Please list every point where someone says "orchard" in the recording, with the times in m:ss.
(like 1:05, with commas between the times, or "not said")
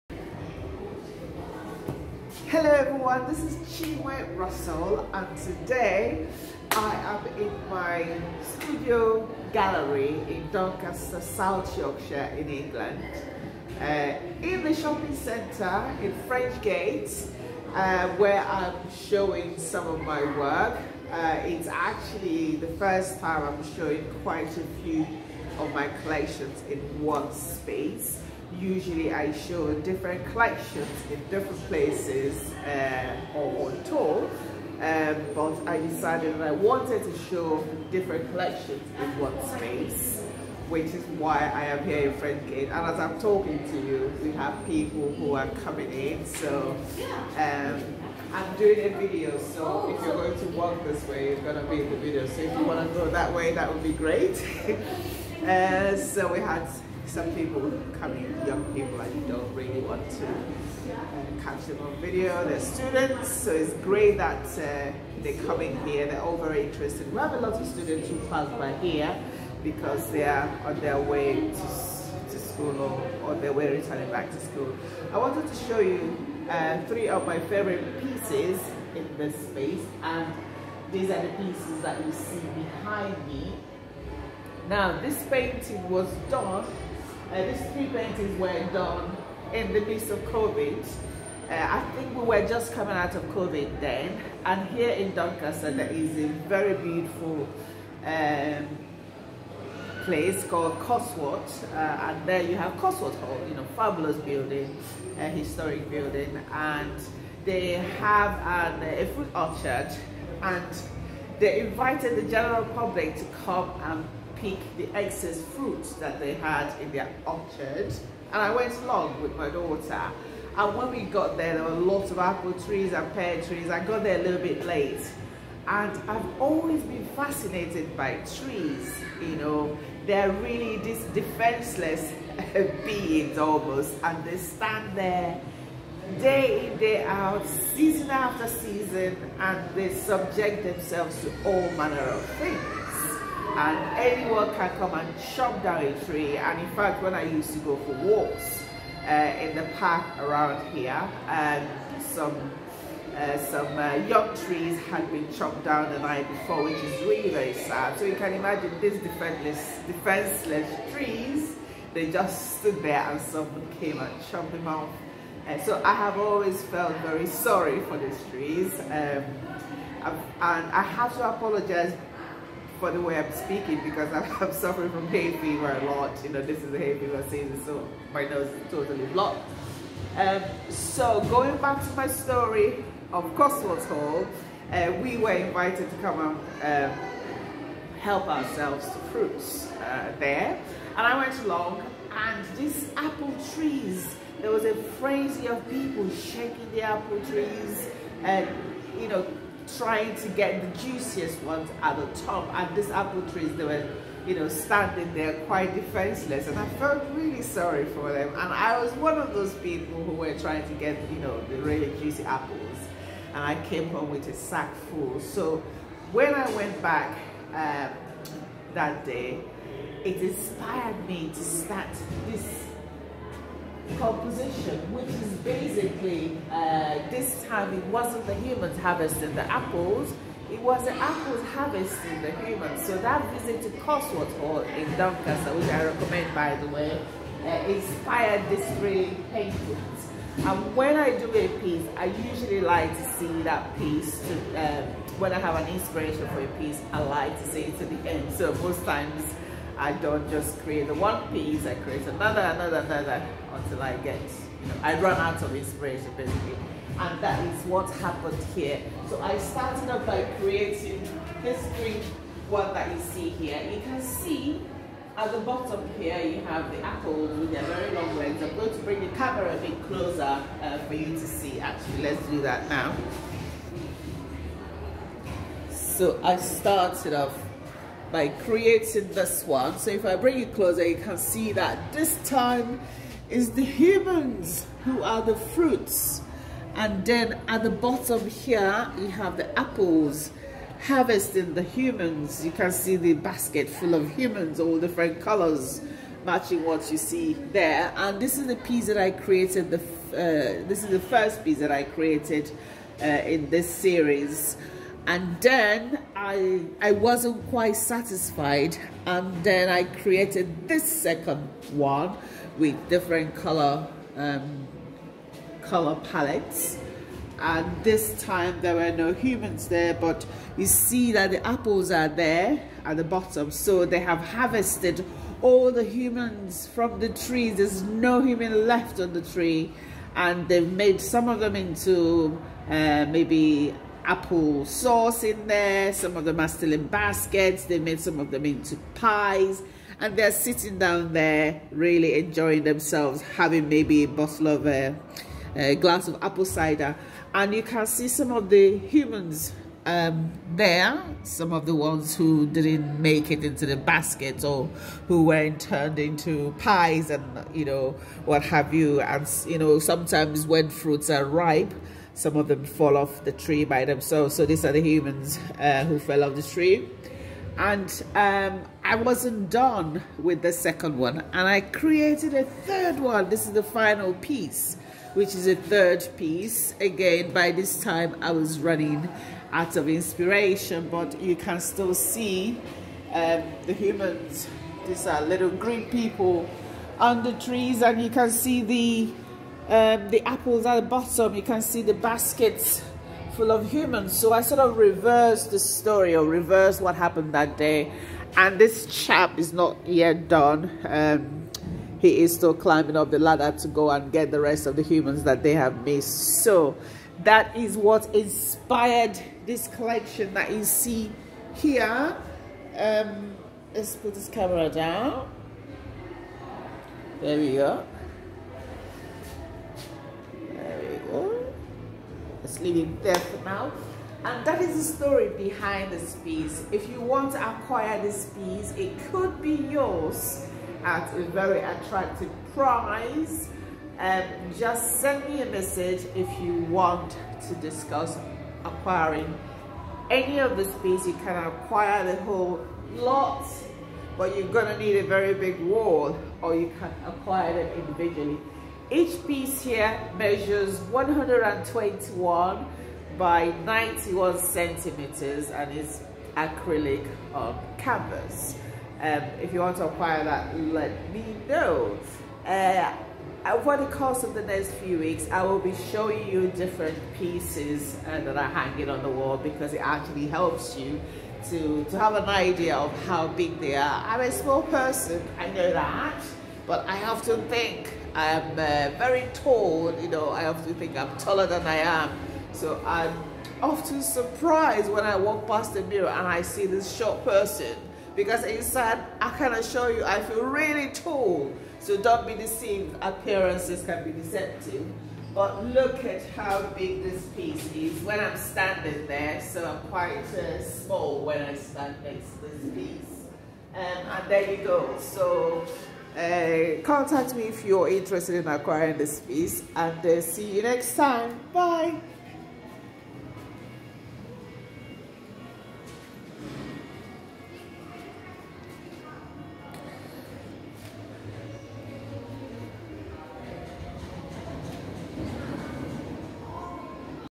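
1:49, 1:57.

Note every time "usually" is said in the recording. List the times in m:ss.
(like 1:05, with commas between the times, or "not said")
0:28, 4:02.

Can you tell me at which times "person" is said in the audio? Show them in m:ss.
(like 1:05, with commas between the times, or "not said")
7:54, 8:07.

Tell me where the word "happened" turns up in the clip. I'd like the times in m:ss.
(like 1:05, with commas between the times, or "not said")
4:17, 6:36.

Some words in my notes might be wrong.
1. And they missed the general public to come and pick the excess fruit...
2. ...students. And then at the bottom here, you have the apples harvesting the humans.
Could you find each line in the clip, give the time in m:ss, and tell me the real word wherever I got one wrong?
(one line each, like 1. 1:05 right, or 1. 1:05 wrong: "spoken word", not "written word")
1. 1:50 wrong: "invited", not "missed"
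2. 4:45 wrong: "fruits", not "students".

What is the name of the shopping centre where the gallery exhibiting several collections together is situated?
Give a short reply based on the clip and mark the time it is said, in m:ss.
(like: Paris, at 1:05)
French Gates, at 0:16.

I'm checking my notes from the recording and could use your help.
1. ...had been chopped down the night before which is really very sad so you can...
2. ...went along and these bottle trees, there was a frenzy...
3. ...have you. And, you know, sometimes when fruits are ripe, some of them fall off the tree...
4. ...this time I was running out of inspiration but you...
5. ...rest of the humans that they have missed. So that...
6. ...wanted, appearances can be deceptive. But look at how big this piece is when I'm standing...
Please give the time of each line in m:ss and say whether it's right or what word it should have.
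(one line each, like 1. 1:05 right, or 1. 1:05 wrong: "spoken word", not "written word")
1. 2:34 right
2. 3:11 wrong: "apple", not "bottle"
3. 5:58 right
4. 6:17 right
5. 6:44 right
6. 8:12 wrong: "deceived", not "wanted".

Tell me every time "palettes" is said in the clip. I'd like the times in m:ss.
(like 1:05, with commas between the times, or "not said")
5:16.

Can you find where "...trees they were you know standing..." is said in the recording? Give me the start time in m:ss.
3:23.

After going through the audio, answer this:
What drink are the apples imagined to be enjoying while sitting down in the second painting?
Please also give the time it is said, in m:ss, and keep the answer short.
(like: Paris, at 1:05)
Apple cider, at 5:46.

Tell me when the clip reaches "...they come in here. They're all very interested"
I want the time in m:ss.
1:05.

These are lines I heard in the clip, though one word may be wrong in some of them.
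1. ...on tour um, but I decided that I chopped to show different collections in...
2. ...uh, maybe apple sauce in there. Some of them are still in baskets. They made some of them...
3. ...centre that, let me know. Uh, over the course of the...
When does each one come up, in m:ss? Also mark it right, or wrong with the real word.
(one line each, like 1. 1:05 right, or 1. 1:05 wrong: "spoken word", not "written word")
1. 0:33 wrong: "wanted", not "chopped"
2. 5:32 right
3. 7:39 wrong: "acquire", not "centre".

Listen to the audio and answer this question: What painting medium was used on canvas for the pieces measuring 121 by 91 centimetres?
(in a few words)
Acrylic.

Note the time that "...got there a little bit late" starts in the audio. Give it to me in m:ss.
2:03.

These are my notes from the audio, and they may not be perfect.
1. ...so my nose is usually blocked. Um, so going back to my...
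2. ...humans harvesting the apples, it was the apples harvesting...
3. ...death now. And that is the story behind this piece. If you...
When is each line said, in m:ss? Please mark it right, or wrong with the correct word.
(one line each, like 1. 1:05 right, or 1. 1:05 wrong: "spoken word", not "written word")
1. 2:57 wrong: "totally", not "usually"
2. 3:48 right
3. 7:03 right.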